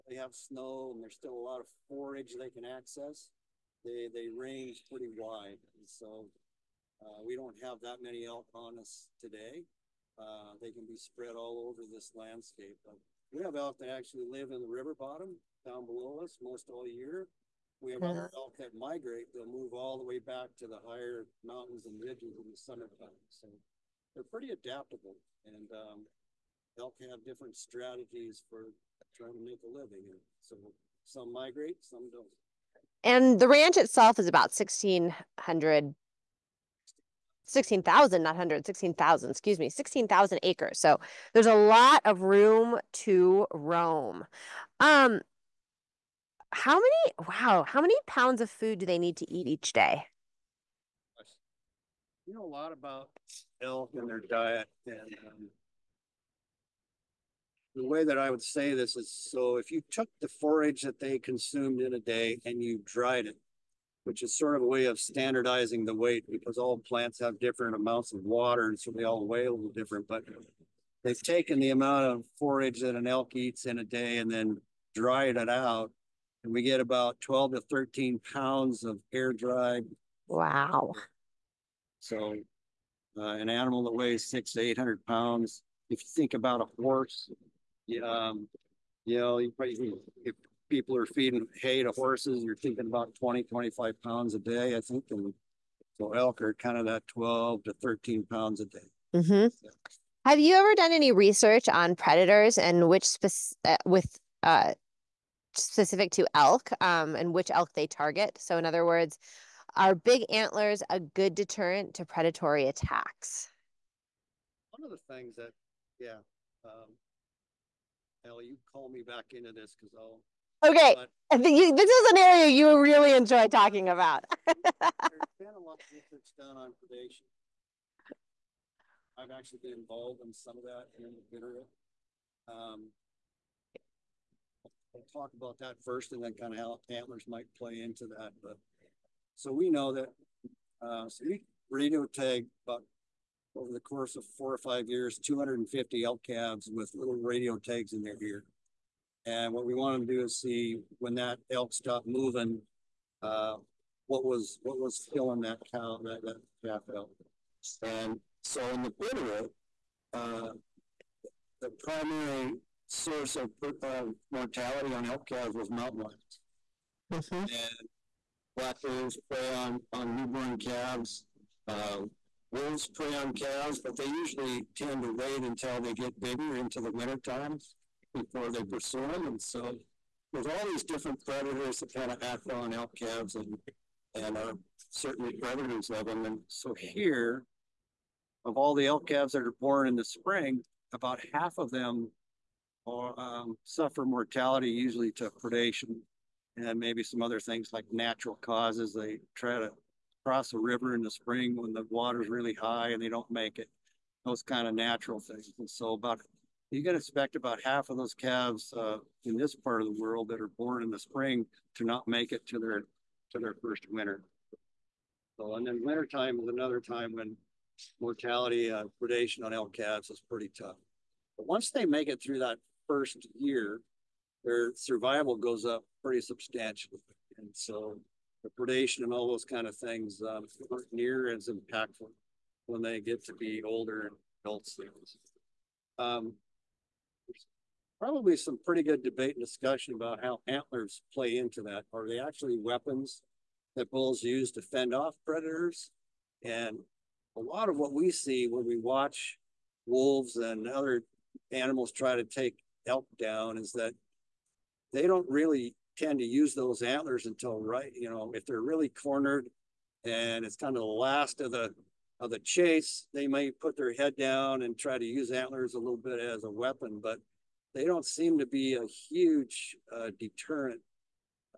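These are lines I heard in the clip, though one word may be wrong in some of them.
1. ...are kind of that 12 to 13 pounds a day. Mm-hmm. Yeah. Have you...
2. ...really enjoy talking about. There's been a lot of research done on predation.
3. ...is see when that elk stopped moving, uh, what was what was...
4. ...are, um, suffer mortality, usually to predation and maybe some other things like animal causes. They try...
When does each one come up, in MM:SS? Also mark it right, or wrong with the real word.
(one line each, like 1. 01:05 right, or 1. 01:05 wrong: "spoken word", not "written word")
1. 01:36 right
2. 02:02 right
3. 02:30 right
4. 03:12 wrong: "natural", not "animal".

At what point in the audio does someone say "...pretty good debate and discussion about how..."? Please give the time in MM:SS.
03:58.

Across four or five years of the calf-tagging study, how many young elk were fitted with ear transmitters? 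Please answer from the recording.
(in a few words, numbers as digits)
250.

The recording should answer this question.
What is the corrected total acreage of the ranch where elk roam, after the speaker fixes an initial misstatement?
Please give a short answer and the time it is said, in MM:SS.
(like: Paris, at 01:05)
16,000 acres, at 00:39.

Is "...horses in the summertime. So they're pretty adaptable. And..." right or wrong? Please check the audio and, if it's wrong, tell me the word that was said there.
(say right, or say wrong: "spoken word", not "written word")
wrong: "ridges", not "horses".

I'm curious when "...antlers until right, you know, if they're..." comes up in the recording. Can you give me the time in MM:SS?
04:16.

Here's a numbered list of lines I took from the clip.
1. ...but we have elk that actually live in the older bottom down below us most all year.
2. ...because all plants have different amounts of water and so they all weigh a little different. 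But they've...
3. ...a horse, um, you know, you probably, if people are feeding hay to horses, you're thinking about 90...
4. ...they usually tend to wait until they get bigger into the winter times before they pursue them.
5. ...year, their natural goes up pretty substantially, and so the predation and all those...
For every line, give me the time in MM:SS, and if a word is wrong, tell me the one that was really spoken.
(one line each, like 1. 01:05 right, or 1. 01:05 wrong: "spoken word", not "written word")
1. 00:12 wrong: "river", not "older"
2. 01:06 right
3. 01:26 wrong: "20", not "90"
4. 02:53 right
5. 03:43 wrong: "survival", not "natural".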